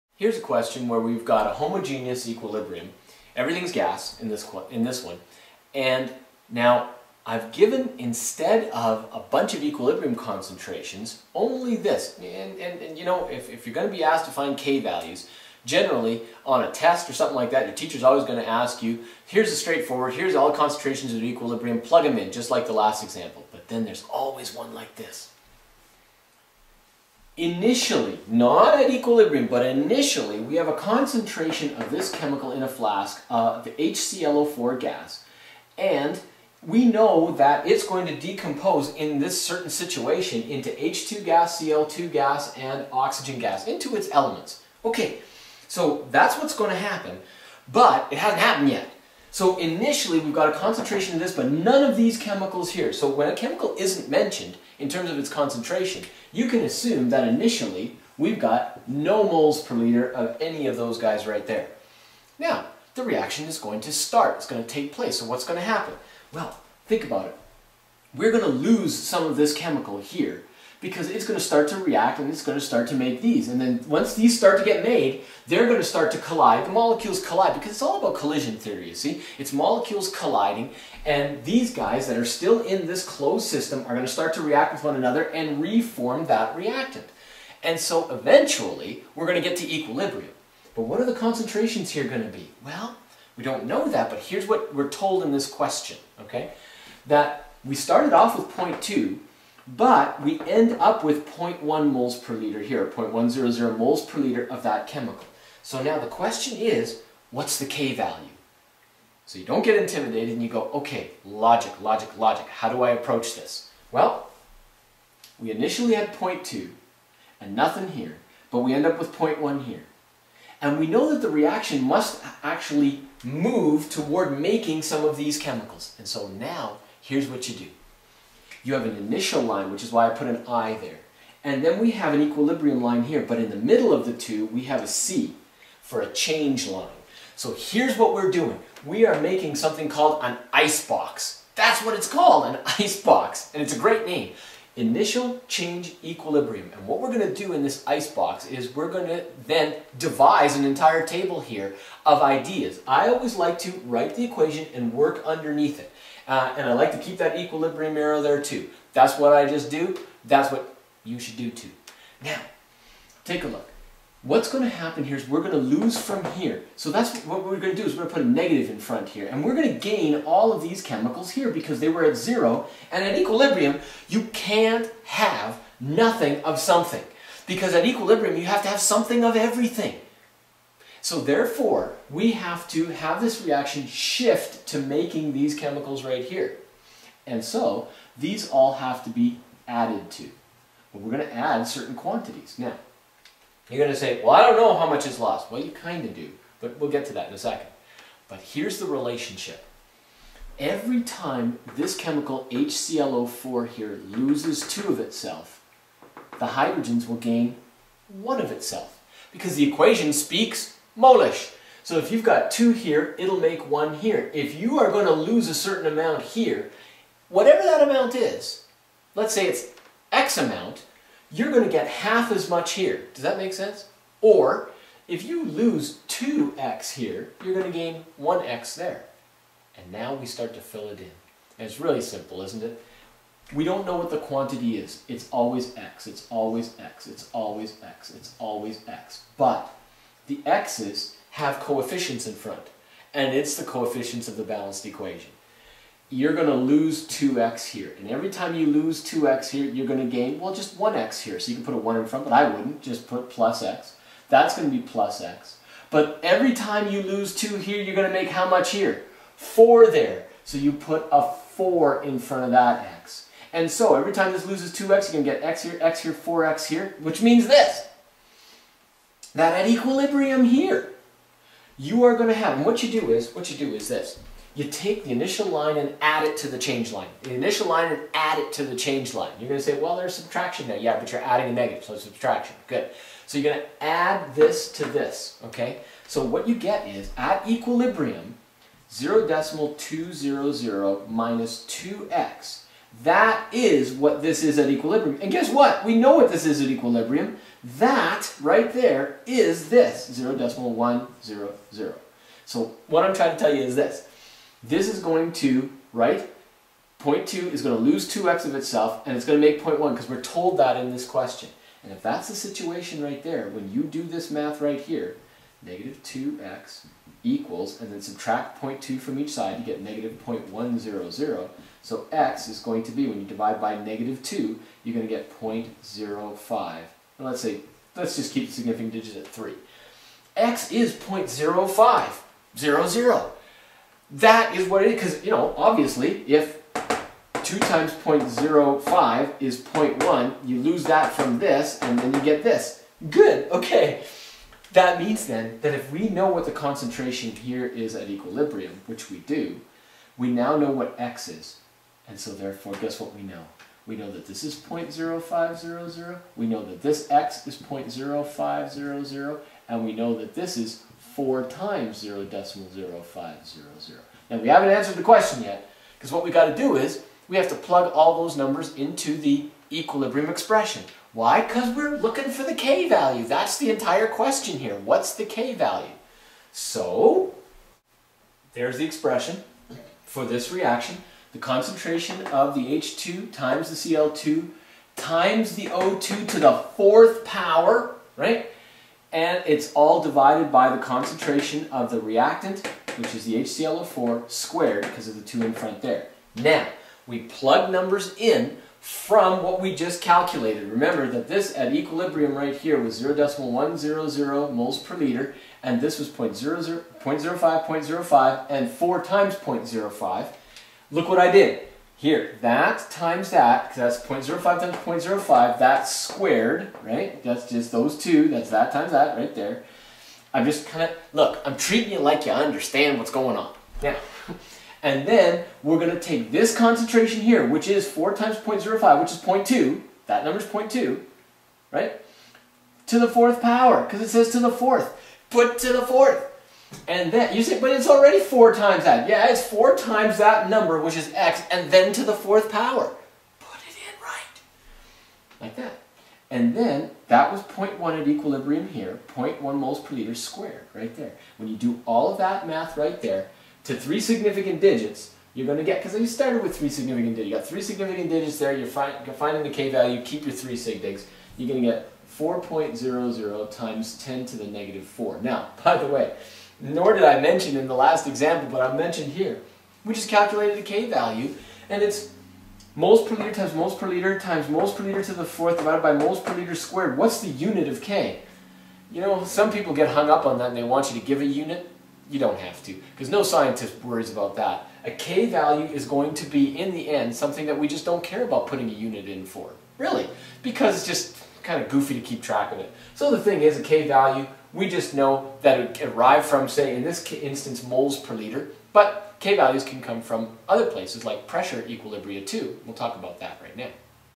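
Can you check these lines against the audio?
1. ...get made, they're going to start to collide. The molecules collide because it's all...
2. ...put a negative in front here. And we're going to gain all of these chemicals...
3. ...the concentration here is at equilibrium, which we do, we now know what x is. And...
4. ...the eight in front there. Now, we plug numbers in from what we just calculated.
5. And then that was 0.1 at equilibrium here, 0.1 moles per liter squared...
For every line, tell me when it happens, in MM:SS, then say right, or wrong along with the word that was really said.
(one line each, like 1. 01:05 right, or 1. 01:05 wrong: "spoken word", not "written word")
1. 01:14 right
2. 02:48 right
3. 05:46 right
4. 06:35 wrong: "two", not "eight"
5. 07:26 right.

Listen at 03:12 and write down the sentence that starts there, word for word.
Now, you're going to say, well, I don't know how much is lost.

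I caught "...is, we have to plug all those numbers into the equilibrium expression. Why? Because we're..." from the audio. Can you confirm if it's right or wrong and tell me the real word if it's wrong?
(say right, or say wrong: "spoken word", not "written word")
right.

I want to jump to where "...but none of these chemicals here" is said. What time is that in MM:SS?
00:51.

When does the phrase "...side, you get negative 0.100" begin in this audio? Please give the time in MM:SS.
05:19.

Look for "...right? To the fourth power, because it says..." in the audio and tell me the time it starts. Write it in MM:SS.
07:11.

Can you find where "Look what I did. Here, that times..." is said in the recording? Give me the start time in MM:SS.
06:50.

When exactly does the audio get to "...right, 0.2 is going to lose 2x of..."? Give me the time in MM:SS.
05:05.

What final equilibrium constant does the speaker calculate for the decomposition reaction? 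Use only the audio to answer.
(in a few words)
4.00 × 10^-4.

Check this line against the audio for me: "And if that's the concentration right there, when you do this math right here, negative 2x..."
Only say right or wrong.
wrong.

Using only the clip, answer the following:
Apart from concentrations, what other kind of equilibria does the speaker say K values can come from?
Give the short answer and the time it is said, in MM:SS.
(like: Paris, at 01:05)
pressure equilibria, at 08:21.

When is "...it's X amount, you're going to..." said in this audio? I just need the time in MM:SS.
03:39.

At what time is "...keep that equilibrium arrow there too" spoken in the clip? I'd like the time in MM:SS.
02:36.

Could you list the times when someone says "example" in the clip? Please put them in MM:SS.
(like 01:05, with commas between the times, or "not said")
00:23, 07:48.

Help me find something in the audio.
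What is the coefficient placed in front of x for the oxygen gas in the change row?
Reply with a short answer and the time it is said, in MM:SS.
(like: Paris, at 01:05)
4, at 04:19.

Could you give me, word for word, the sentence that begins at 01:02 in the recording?
Now, the reaction is going to start.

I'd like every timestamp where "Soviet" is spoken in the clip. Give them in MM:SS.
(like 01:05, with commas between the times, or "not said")
not said.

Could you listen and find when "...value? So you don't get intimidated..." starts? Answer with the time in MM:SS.
01:47.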